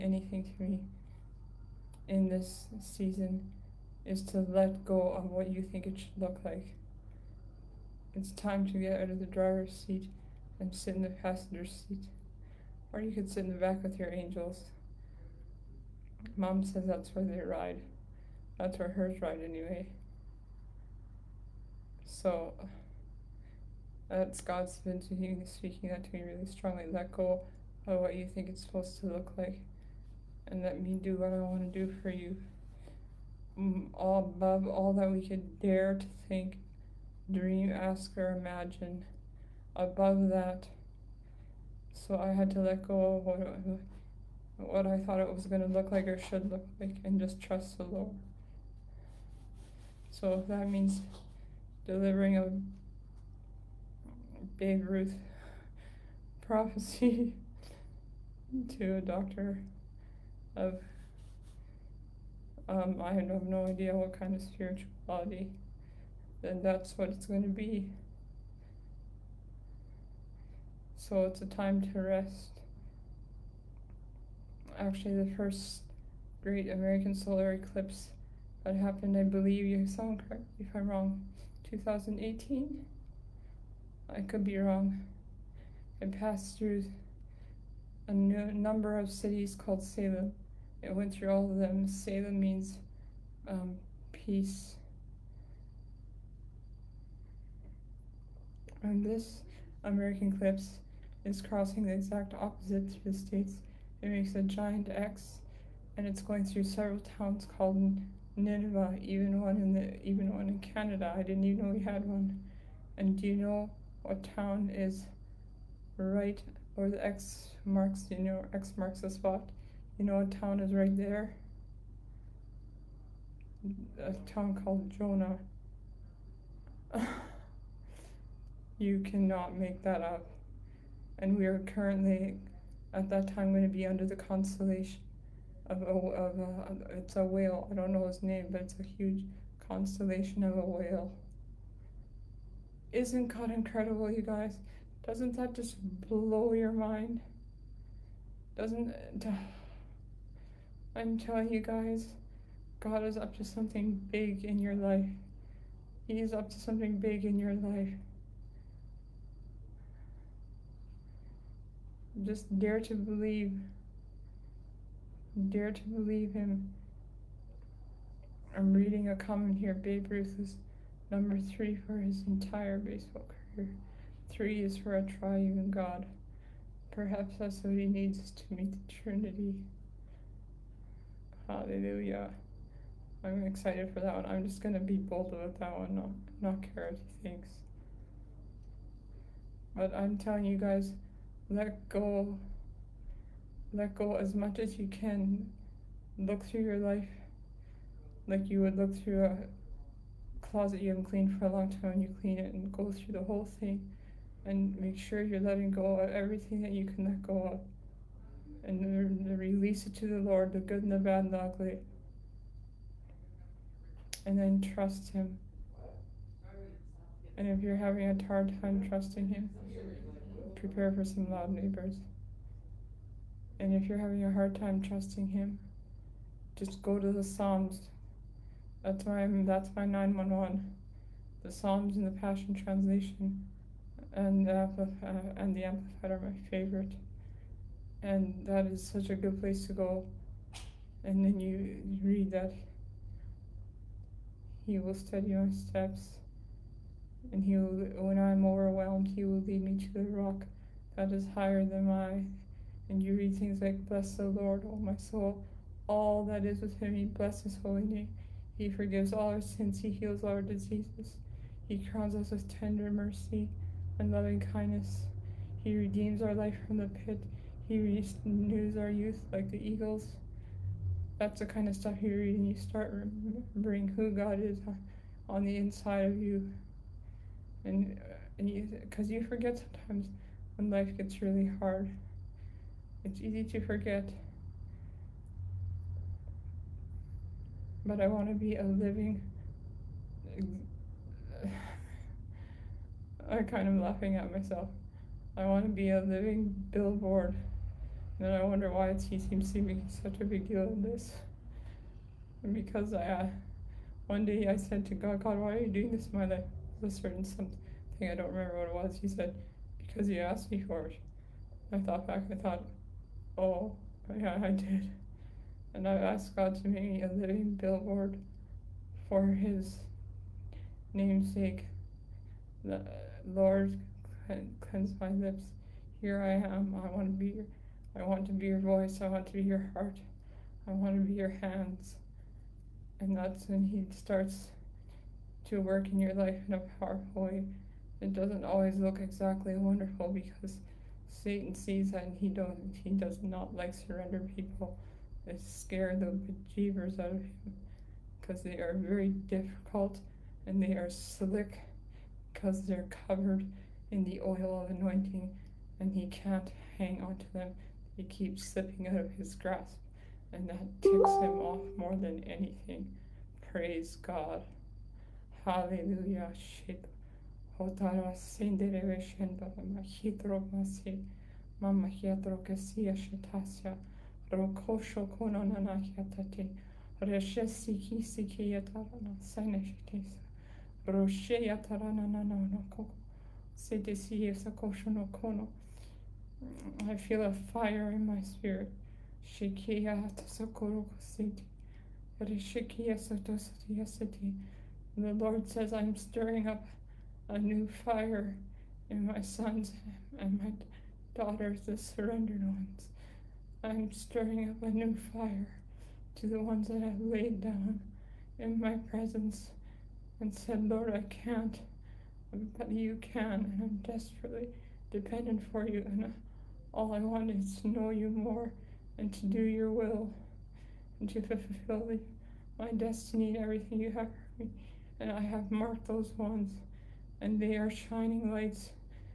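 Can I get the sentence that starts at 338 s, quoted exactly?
It doesn't always look exactly wonderful because Satan sees that and he don't he does not like surrender people.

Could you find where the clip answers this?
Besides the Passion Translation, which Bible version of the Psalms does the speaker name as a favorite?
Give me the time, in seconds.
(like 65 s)
235 s.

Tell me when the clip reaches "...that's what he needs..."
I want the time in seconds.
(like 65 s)
177 s.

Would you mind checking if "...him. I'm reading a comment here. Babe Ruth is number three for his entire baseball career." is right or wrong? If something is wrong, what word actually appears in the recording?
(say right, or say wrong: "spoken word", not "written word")
right.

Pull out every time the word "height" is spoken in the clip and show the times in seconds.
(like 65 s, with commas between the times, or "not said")
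not said.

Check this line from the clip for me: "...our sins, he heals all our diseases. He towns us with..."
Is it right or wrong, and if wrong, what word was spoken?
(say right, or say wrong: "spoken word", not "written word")
wrong: "crowns", not "towns".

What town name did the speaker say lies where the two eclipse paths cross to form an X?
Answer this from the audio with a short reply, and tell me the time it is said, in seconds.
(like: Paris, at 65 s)
Jonah, at 124 s.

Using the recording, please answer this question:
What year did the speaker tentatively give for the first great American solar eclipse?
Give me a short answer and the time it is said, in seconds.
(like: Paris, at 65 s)
2018, at 81 s.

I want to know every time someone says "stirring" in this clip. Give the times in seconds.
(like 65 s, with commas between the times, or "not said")
395 s, 403 s.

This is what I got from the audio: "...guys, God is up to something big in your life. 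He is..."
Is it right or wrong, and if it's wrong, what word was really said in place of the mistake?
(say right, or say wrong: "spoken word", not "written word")
right.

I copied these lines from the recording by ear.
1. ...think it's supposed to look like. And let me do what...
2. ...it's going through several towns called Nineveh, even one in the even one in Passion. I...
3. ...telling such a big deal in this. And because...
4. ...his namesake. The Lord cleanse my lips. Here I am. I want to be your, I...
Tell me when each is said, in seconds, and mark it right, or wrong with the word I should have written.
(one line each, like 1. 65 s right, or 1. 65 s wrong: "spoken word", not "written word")
1. 28 s right
2. 106 s wrong: "Canada", not "Passion"
3. 299 s wrong: "making", not "telling"
4. 319 s right.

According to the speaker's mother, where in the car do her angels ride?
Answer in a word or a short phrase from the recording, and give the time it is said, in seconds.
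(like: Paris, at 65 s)
In the back, at 13 s.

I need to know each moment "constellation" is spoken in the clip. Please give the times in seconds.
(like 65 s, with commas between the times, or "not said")
134 s, 139 s.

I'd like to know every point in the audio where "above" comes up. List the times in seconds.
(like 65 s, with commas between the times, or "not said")
34 s, 39 s.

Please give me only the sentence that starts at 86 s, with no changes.
It passed through a number of cities called Salem.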